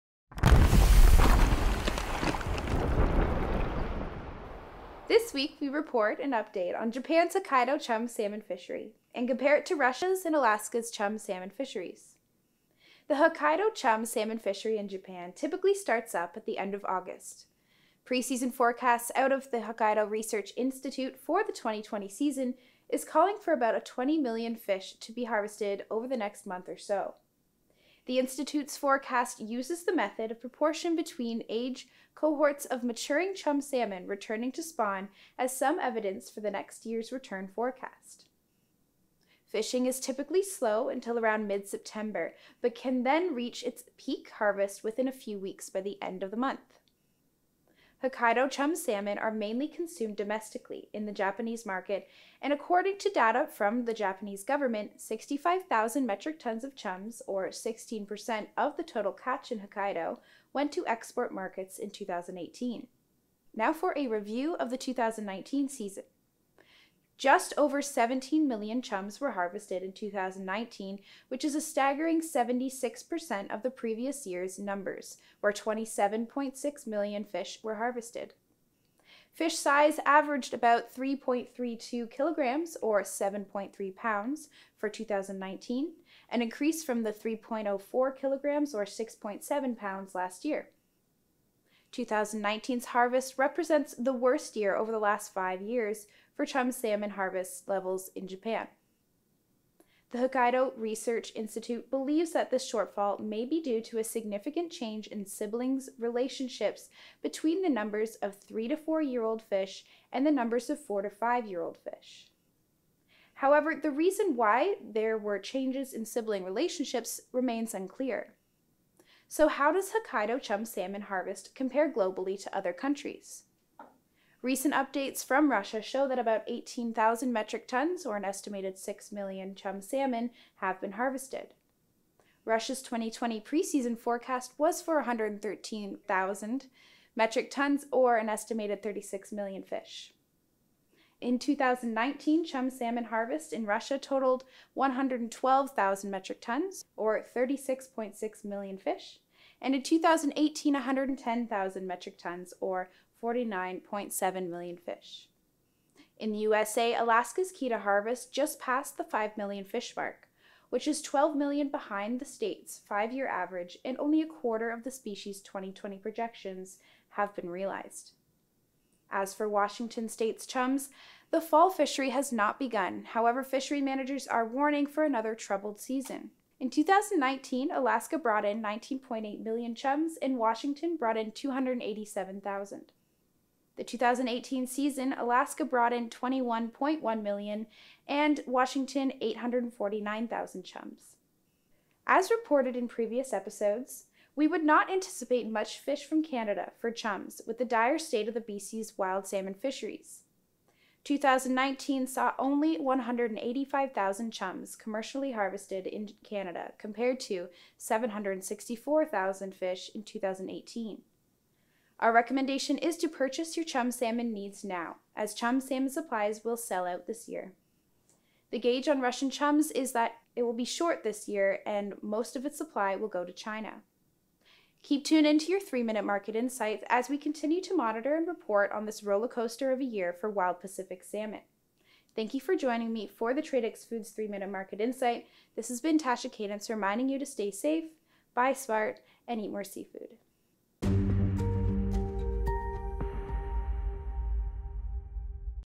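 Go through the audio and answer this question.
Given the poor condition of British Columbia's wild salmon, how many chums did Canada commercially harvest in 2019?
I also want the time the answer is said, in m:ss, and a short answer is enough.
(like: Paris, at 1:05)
185,000, at 3:22.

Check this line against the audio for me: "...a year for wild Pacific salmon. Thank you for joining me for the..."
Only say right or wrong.
right.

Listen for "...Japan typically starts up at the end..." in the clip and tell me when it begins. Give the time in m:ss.
0:14.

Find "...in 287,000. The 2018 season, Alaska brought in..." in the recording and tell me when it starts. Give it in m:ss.
3:01.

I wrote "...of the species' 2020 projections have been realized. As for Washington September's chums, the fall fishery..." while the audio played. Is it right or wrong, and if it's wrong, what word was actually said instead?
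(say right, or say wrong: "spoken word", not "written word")
wrong: "State", not "September".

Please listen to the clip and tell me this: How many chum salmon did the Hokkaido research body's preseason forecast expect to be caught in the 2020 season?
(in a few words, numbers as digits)
20 million.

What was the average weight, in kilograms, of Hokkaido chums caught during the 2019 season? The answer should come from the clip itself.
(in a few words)
3.32 kilograms.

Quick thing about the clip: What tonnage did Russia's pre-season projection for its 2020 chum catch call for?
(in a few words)
113,000 metric tons.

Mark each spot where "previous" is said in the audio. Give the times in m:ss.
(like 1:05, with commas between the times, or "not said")
1:13, 3:12.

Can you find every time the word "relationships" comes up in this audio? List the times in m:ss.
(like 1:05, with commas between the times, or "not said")
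1:45, 1:56.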